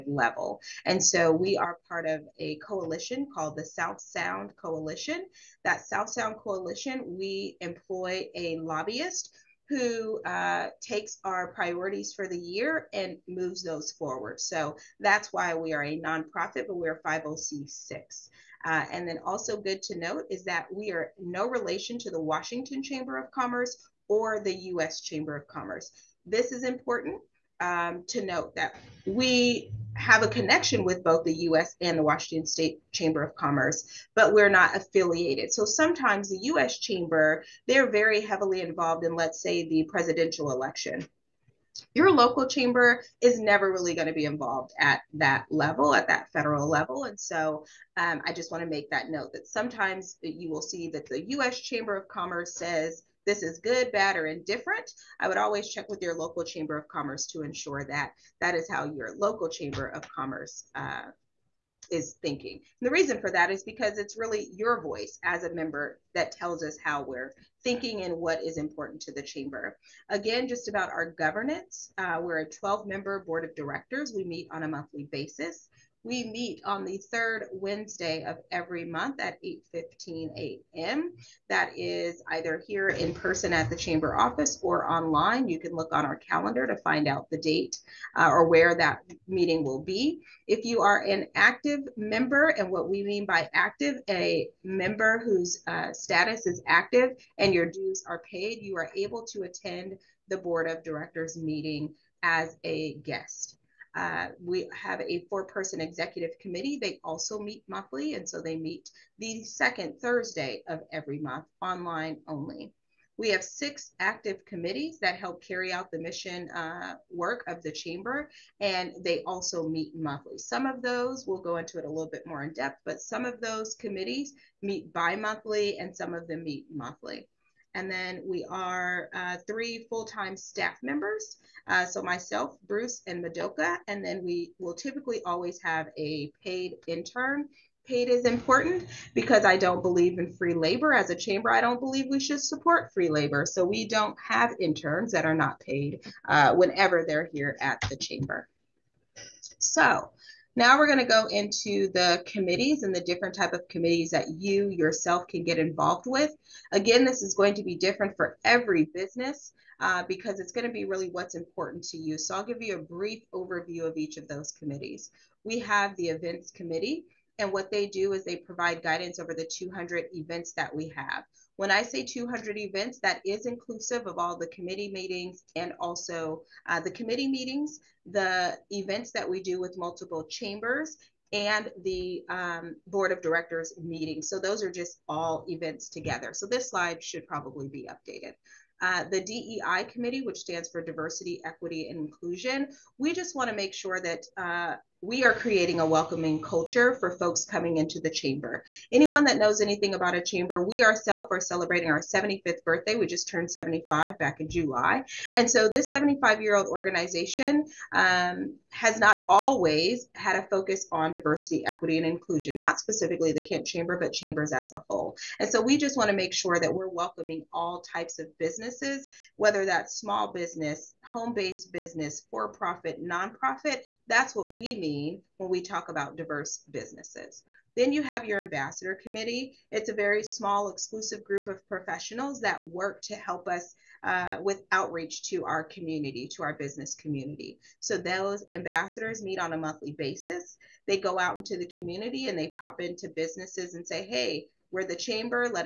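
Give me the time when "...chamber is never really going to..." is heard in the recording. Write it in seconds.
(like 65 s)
42 s.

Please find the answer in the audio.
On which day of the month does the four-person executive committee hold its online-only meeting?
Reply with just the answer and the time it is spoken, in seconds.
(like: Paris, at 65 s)
Second Thursday, at 109 s.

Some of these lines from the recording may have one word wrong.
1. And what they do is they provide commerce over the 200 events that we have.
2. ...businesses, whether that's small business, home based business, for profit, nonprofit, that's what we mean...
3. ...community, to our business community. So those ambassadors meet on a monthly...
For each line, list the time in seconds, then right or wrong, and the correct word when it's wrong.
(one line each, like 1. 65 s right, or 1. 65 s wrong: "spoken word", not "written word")
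1. 167 s wrong: "guidance", not "commerce"
2. 218 s right
3. 235 s right.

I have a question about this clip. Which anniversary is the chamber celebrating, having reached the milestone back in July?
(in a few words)
75th.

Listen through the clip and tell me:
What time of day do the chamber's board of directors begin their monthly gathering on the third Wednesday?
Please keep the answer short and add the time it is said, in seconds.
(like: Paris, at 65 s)
8:15 a.m., at 79 s.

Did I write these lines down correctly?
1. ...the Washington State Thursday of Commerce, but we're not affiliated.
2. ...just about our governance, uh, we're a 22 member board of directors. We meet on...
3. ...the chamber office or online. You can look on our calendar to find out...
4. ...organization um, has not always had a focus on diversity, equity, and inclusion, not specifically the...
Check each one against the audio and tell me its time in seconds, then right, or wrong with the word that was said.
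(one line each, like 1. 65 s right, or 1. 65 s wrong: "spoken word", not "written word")
1. 31 s wrong: "Chamber", not "Thursday"
2. 70 s wrong: "12", not "22"
3. 83 s right
4. 206 s right.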